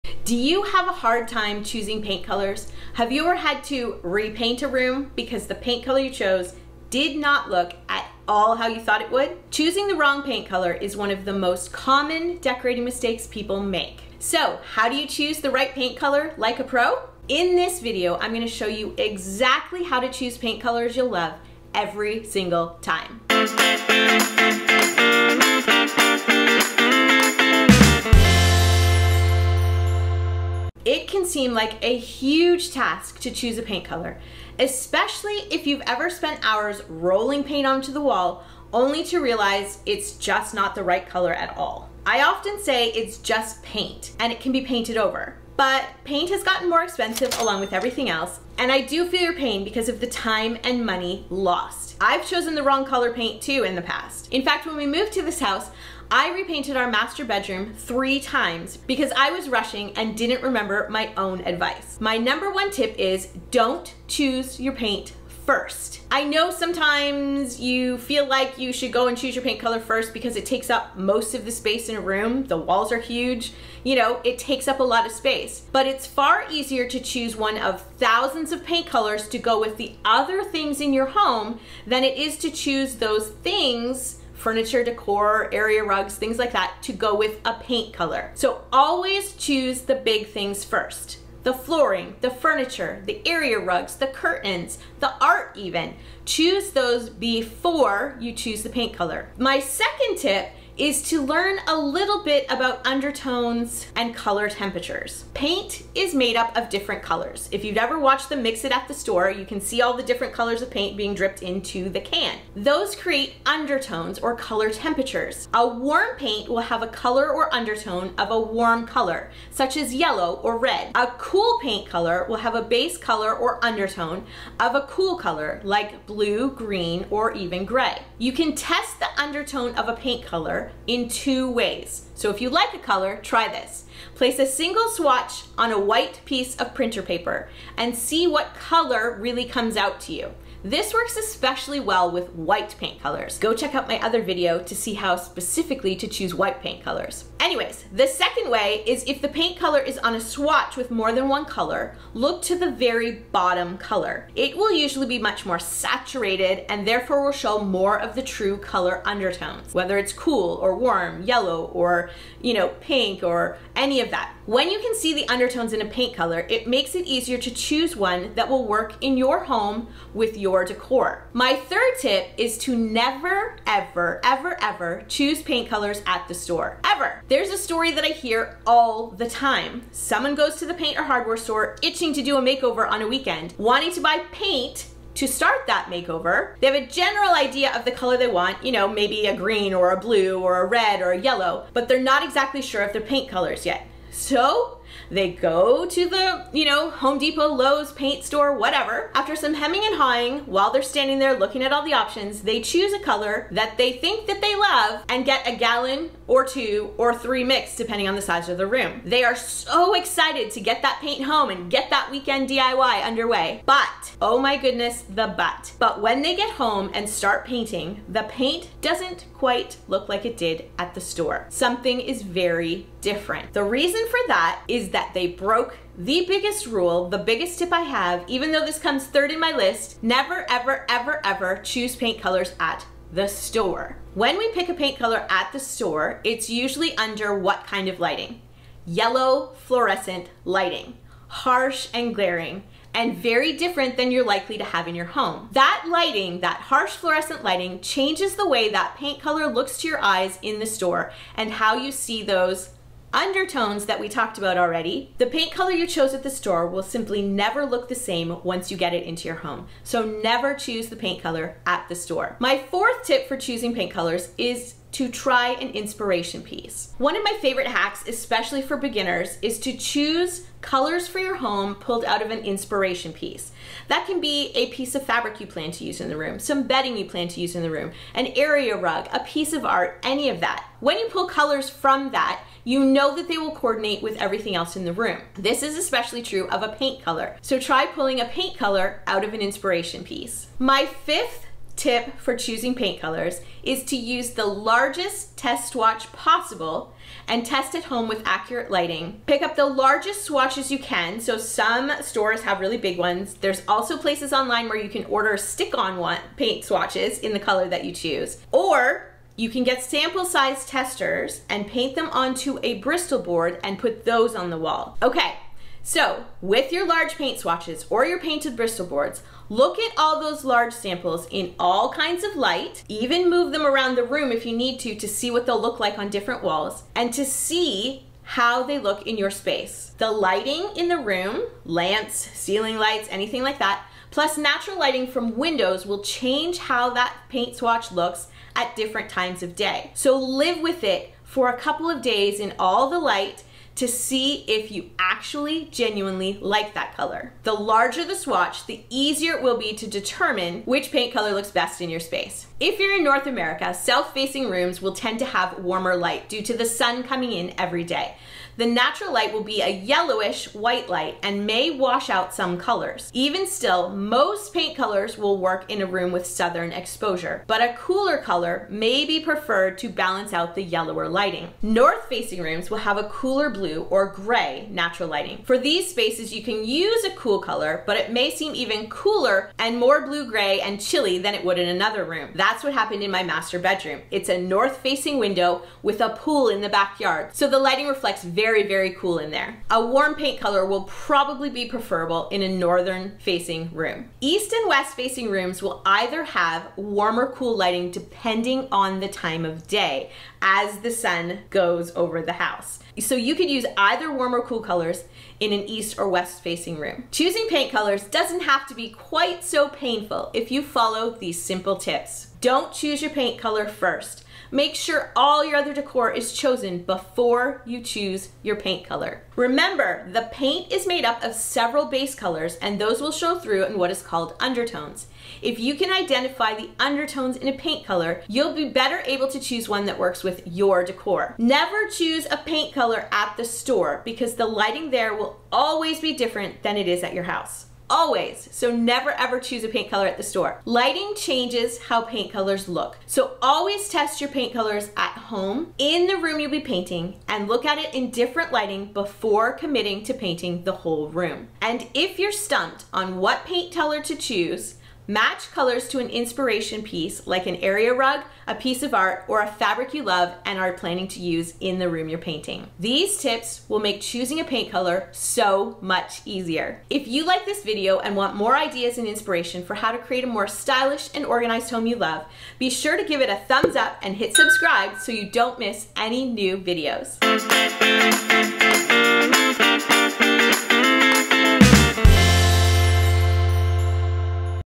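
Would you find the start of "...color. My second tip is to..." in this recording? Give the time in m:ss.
1:38.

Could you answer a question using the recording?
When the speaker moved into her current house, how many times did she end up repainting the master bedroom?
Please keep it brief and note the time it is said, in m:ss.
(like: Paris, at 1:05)
3, at 0:57.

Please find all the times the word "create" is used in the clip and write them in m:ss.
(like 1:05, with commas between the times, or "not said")
1:52, 7:49.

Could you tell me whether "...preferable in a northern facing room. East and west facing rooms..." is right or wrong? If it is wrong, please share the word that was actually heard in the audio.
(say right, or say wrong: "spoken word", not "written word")
right.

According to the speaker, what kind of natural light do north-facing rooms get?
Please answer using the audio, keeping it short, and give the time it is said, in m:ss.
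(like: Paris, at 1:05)
Cooler blue or gray, at 6:13.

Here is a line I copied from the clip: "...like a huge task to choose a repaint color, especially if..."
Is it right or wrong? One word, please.
wrong.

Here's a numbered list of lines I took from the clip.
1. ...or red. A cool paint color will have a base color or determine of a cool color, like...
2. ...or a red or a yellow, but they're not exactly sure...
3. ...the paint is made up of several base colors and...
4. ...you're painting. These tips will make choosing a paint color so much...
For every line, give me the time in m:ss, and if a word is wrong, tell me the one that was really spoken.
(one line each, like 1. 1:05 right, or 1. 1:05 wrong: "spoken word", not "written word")
1. 2:00 wrong: "undertone", not "determine"
2. 3:10 right
3. 7:00 right
4. 7:42 right.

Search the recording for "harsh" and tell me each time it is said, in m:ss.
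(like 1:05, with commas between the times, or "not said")
4:01, 4:06.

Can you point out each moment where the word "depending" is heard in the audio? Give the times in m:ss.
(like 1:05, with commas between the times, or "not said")
3:27, 6:37.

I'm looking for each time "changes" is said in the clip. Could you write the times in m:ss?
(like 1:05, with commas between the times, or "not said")
4:07, 5:36, 7:21.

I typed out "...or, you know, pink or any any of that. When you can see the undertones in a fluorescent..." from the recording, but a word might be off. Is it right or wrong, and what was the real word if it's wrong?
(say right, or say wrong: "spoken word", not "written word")
wrong: "paint", not "fluorescent".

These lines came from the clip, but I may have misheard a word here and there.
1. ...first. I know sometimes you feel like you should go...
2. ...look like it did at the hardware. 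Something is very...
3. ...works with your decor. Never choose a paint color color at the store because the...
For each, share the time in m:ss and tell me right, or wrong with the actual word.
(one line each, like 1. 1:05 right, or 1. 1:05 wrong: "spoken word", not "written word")
1. 1:05 right
2. 3:39 wrong: "store", not "hardware"
3. 7:09 right.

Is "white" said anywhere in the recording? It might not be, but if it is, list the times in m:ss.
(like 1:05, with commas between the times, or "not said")
2:15, 2:22, 2:26, 6:00.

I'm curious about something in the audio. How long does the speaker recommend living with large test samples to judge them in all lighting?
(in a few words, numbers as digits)
A couple of days.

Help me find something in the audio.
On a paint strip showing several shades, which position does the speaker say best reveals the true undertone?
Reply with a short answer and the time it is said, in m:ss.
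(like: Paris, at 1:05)
The very bottom color, at 2:32.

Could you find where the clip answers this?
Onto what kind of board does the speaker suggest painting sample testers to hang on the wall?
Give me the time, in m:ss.
5:12.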